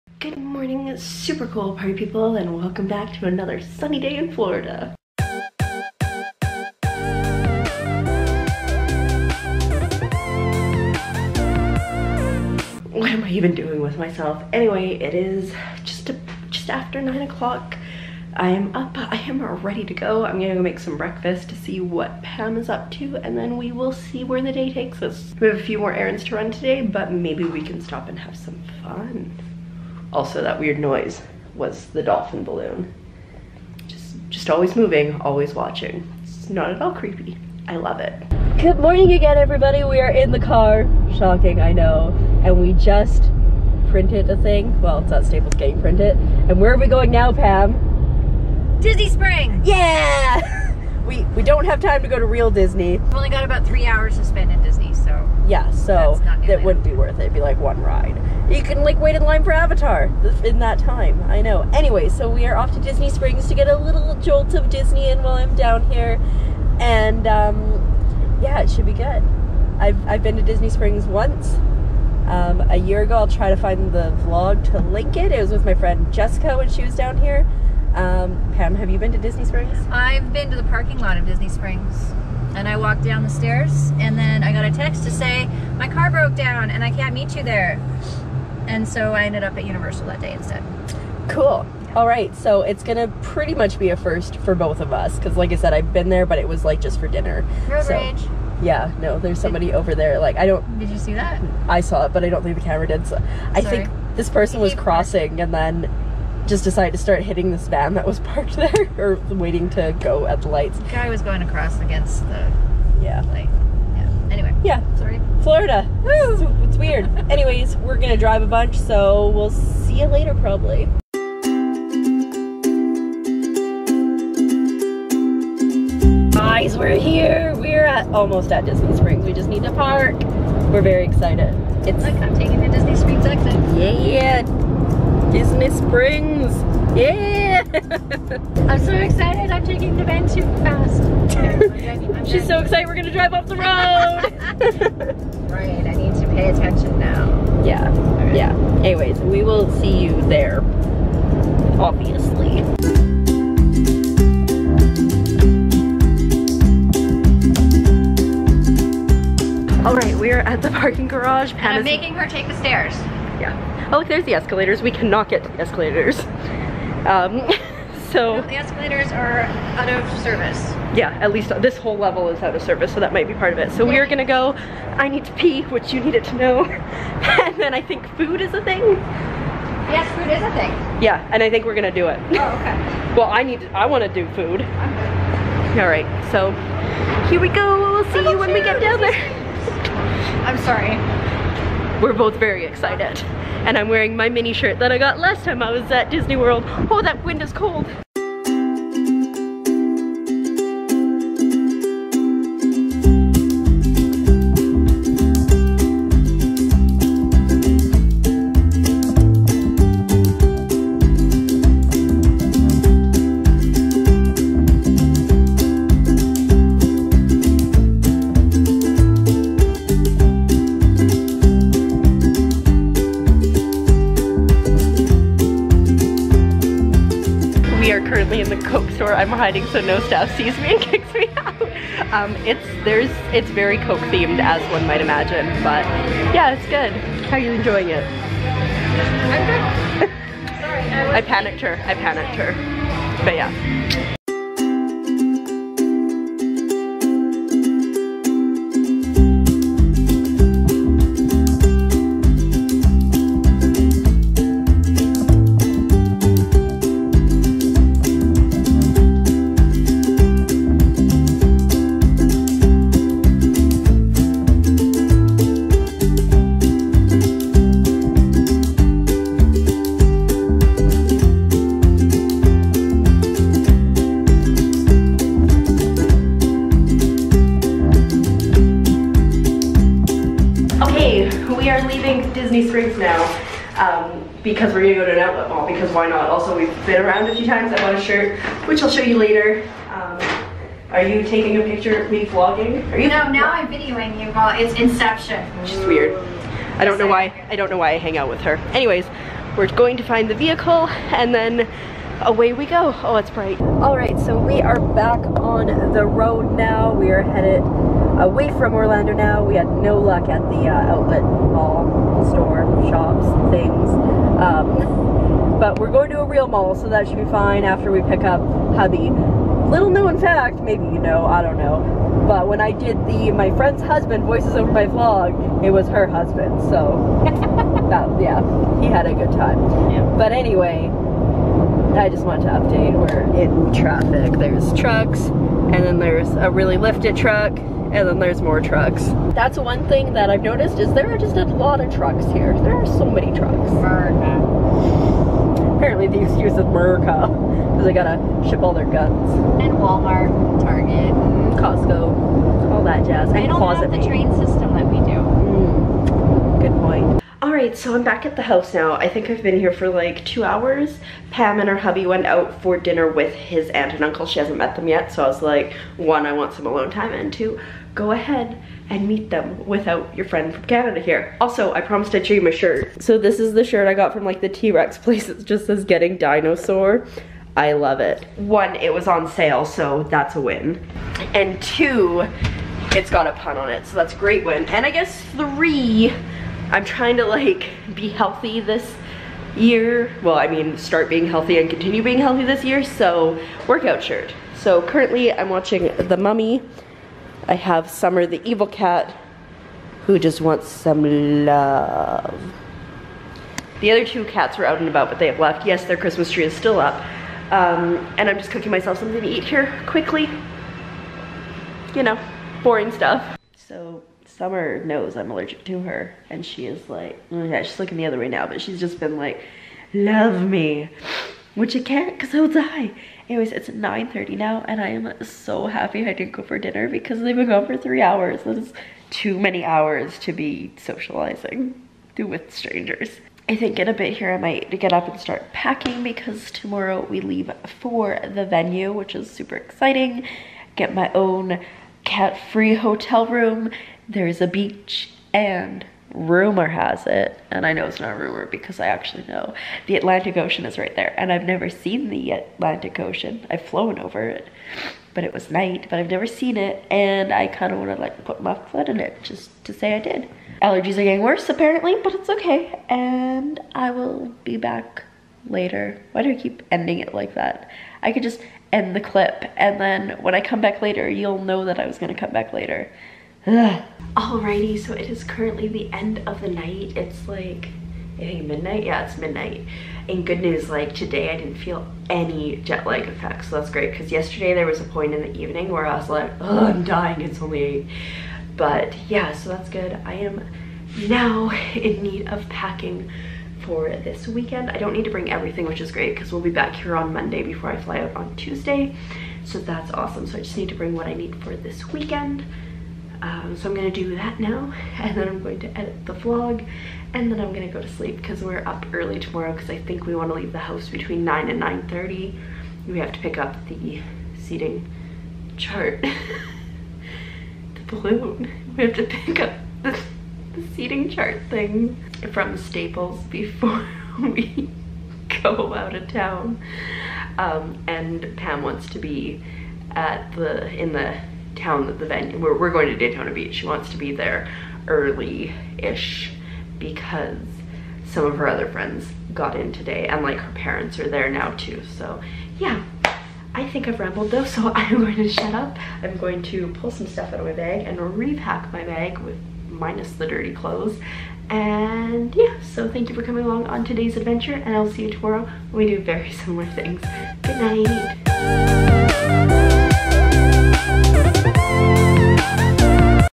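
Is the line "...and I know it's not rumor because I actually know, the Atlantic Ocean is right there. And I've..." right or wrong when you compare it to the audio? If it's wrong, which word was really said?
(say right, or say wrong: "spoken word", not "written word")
right.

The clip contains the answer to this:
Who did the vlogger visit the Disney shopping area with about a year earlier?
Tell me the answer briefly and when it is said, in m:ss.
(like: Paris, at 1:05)
Jessica, at 1:15.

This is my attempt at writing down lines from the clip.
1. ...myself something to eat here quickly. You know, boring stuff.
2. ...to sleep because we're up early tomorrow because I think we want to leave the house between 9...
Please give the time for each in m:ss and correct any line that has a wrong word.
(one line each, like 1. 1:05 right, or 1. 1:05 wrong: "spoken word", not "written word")
1. 6:48 right
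2. 8:27 right.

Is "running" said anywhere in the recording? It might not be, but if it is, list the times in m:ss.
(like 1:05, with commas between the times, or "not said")
not said.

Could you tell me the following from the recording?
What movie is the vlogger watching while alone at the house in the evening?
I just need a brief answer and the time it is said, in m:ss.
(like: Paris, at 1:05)
The Mummy, at 6:35.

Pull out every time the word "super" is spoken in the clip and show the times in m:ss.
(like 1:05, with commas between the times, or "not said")
0:00, 7:19.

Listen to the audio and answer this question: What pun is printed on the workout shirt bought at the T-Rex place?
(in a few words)
Getting dinosaur.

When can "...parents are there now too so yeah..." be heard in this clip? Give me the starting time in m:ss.
9:00.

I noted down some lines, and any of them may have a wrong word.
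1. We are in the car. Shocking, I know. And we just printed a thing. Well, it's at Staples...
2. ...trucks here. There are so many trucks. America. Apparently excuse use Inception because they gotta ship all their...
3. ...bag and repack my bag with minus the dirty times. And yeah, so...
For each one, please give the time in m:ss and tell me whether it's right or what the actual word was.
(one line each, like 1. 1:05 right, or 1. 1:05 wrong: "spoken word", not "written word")
1. 0:39 right
2. 5:41 wrong: "America", not "Inception"
3. 9:07 wrong: "clothes", not "times".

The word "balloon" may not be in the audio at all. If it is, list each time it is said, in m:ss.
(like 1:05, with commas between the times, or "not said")
0:32, 8:37.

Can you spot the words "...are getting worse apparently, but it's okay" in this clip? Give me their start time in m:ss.
7:40.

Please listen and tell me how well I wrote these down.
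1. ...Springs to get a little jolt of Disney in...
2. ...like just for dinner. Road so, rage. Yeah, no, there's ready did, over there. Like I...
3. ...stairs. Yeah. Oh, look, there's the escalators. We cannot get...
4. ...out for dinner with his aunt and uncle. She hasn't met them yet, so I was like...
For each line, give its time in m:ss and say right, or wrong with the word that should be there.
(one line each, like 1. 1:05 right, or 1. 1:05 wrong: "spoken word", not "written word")
1. 1:03 right
2. 1:36 wrong: "somebody", not "ready"
3. 2:42 right
4. 6:02 right.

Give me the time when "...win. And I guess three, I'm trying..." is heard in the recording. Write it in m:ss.
6:24.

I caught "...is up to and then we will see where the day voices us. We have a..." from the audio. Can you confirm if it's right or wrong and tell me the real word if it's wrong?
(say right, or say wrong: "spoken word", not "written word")
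wrong: "takes", not "voices".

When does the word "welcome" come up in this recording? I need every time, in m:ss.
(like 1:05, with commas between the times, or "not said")
0:02.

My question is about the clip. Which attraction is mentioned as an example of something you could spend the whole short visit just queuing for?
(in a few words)
Avatar.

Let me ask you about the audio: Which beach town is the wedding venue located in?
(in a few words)
Daytona Beach.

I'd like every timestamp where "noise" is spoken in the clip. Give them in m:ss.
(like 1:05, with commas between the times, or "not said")
0:30.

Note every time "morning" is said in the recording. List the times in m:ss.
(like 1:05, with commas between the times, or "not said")
0:00, 0:38.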